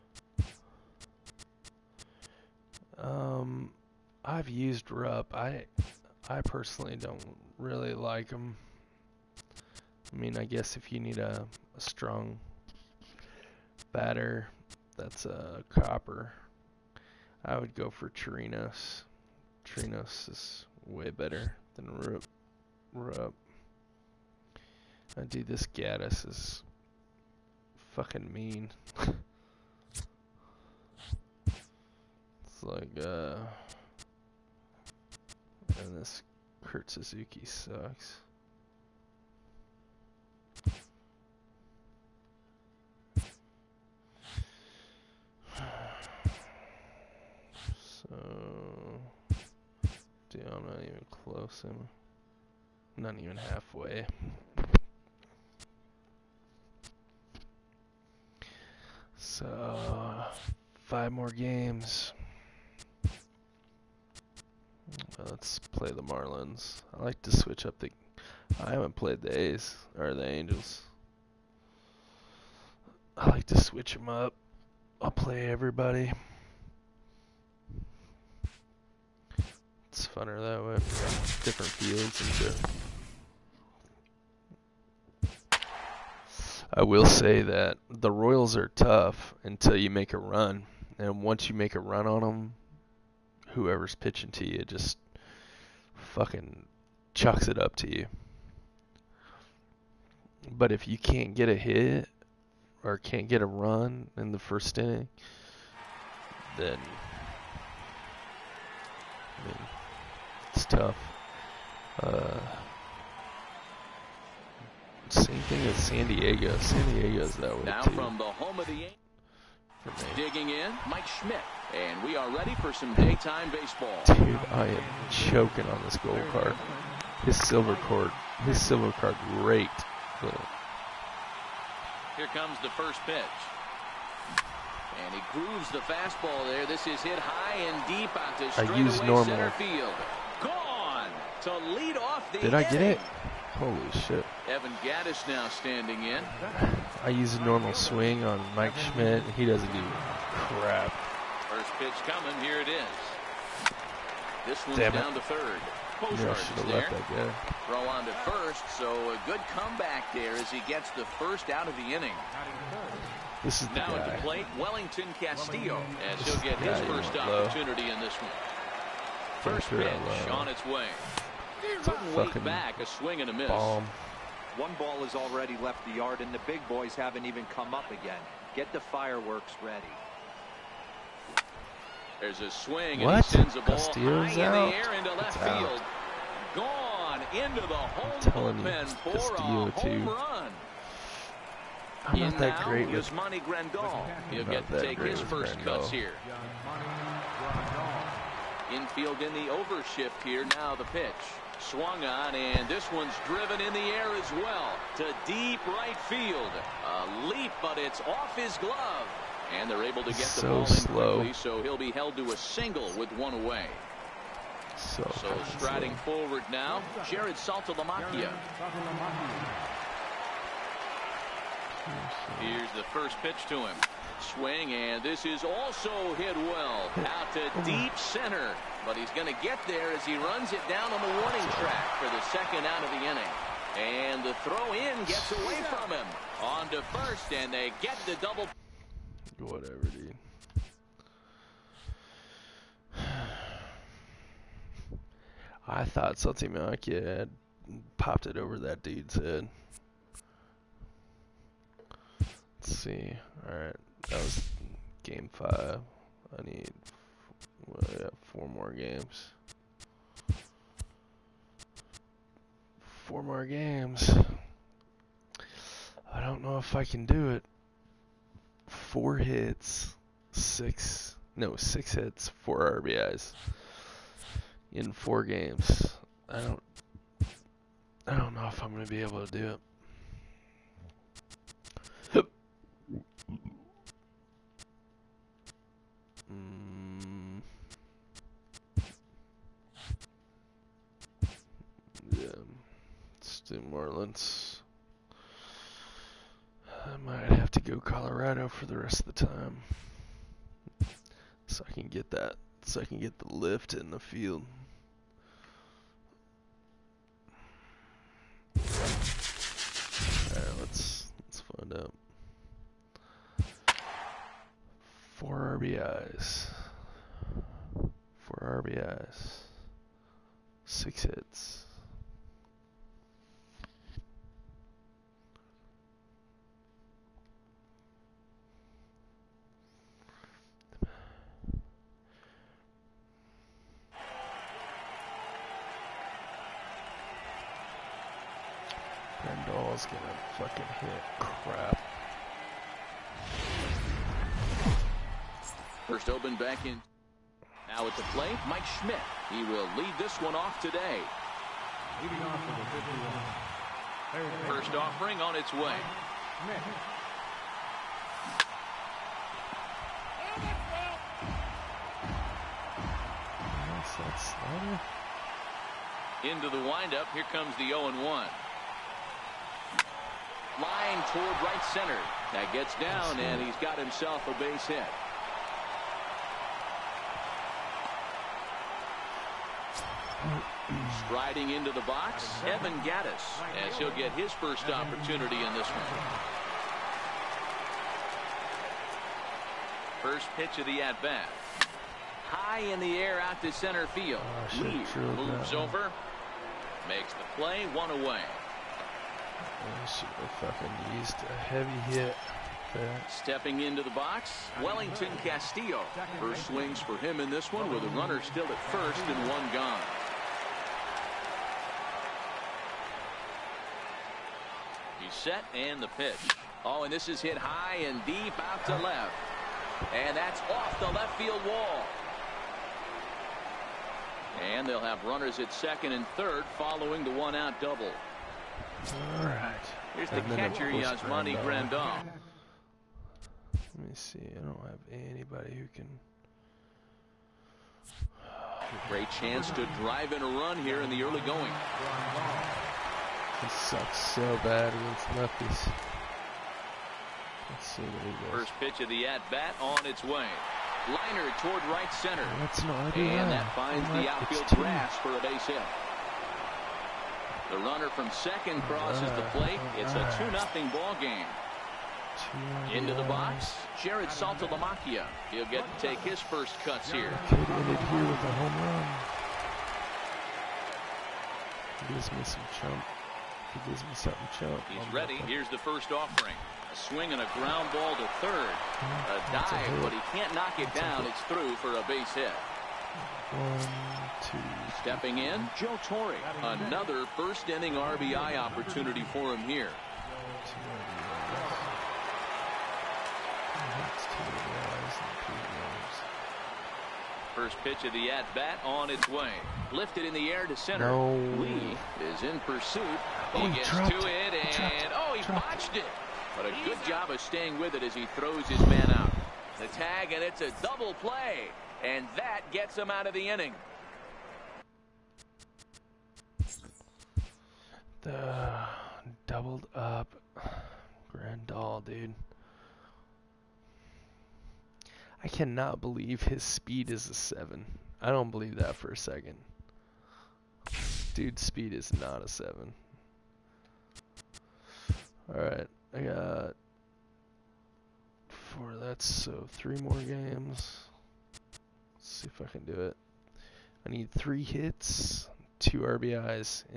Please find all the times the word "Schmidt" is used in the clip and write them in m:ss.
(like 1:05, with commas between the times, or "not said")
2:01, 2:28, 5:48.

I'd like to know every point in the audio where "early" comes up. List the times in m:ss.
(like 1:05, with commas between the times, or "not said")
7:21.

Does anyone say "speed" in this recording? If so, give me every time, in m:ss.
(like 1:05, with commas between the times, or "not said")
8:46, 8:51.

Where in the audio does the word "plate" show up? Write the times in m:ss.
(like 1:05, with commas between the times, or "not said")
2:44, 5:48, 7:39.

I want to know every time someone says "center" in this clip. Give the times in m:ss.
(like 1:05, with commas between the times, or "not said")
2:19, 3:47, 6:11, 6:33, 7:31, 8:20.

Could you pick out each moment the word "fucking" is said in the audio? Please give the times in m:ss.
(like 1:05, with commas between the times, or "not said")
0:27, 1:36, 5:40, 6:40, 7:23.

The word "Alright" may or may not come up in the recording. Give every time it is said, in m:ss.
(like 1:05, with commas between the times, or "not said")
4:13, 5:10, 8:55.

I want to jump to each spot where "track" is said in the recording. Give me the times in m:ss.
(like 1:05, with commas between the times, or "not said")
3:51.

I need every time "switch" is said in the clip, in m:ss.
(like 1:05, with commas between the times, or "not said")
1:07, 1:13.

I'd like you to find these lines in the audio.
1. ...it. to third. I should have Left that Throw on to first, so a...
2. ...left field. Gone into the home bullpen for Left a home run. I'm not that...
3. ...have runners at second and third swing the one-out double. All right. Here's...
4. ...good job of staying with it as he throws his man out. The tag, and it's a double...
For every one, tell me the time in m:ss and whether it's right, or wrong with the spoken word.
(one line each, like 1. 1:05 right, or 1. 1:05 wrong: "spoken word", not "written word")
1. 2:35 right
2. 3:05 wrong: "Castillo", not "Left"
3. 7:04 wrong: "following", not "swing"
4. 8:26 right.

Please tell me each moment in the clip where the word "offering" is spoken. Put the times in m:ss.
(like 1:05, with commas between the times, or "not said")
5:54, 7:55.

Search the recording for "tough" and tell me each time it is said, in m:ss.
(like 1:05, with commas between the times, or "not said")
1:28, 1:50.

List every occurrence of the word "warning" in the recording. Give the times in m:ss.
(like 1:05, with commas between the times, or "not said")
3:51.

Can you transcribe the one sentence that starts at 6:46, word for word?
First swings for him in this one with a runner still at first and one gone.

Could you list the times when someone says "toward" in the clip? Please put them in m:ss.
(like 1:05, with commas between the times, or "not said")
6:11, 7:31.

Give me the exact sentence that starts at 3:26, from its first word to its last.
A leap, but it's off his glove.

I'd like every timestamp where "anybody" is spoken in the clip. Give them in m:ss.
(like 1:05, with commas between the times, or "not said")
7:14.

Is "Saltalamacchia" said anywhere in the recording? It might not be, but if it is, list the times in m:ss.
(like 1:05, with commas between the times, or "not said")
3:37, 7:44.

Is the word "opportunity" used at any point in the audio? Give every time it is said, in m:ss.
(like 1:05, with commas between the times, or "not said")
2:47, 6:24, 8:08.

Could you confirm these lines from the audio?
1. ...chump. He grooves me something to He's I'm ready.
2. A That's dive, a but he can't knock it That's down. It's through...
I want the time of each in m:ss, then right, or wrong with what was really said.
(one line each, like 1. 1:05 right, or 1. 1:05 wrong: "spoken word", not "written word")
1. 7:52 wrong: "gives", not "grooves"
2. 7:58 right.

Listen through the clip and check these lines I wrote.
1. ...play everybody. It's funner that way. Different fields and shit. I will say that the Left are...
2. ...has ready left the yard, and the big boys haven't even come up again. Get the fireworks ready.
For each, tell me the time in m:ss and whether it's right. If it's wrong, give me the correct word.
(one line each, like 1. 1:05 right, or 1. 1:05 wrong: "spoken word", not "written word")
1. 1:15 wrong: "Royals", not "Left"
2. 2:55 wrong: "already", not "ready".